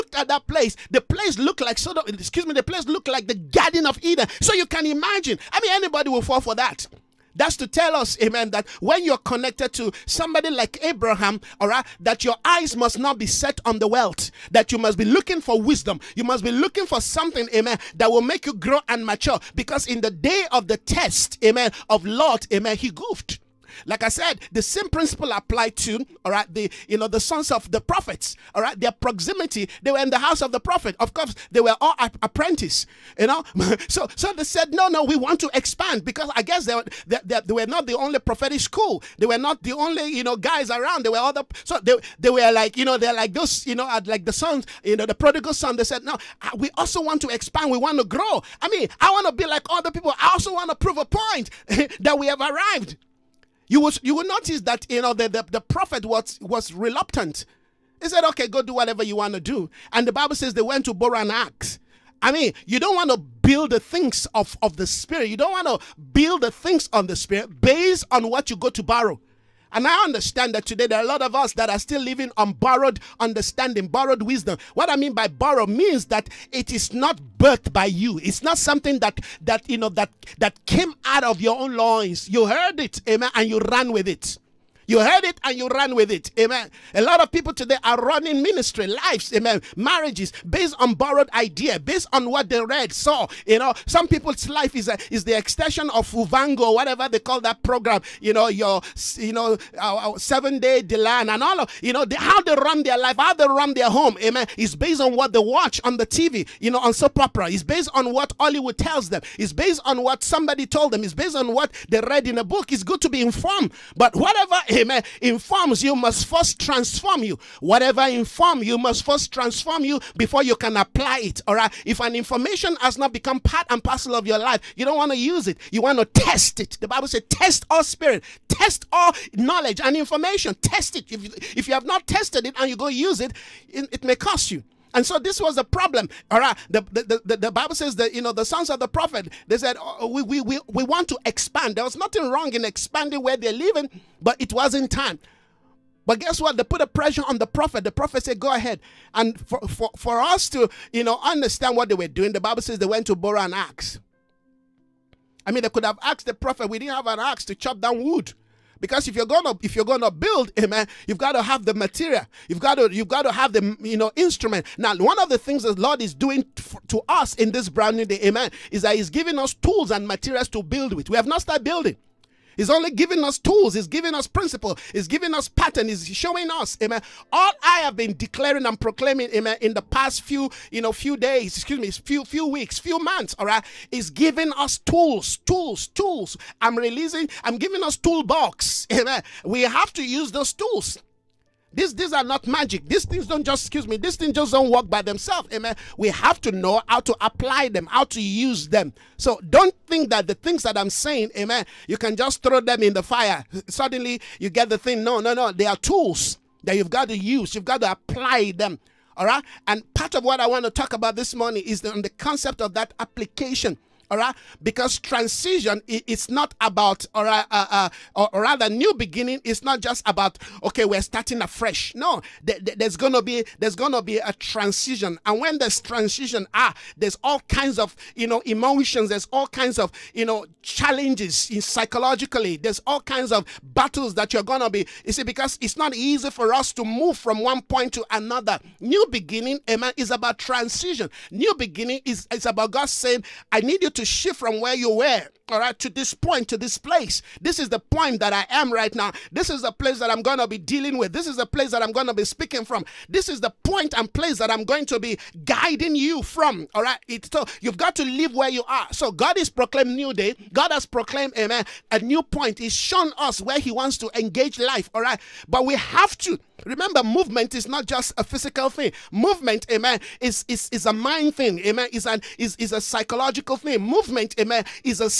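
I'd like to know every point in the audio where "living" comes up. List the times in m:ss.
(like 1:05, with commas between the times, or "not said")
1:12, 2:23.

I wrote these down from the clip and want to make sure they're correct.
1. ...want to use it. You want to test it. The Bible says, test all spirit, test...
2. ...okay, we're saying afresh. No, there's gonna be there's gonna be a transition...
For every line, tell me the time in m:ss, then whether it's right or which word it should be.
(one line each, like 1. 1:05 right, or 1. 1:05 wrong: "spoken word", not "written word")
1. 2:04 right
2. 3:40 wrong: "starting", not "saying".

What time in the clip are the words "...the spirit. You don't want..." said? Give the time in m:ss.
1:04.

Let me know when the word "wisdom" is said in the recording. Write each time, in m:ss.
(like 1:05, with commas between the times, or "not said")
0:15, 1:14.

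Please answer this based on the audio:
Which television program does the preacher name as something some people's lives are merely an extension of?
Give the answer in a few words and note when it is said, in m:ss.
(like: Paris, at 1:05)
Muvhango, at 1:36.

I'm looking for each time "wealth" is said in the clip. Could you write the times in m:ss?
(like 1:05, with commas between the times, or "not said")
0:13.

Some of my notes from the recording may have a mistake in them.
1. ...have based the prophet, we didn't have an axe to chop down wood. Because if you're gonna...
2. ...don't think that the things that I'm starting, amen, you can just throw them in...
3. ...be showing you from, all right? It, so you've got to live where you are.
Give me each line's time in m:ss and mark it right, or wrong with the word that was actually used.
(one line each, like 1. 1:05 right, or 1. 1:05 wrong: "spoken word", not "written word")
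1. 2:35 wrong: "asked", not "based"
2. 3:19 wrong: "saying", not "starting"
3. 4:14 wrong: "guiding", not "showing".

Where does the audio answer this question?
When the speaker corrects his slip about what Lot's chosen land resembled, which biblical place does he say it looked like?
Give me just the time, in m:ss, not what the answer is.
0:03.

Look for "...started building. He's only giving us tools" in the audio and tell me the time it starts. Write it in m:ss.
2:51.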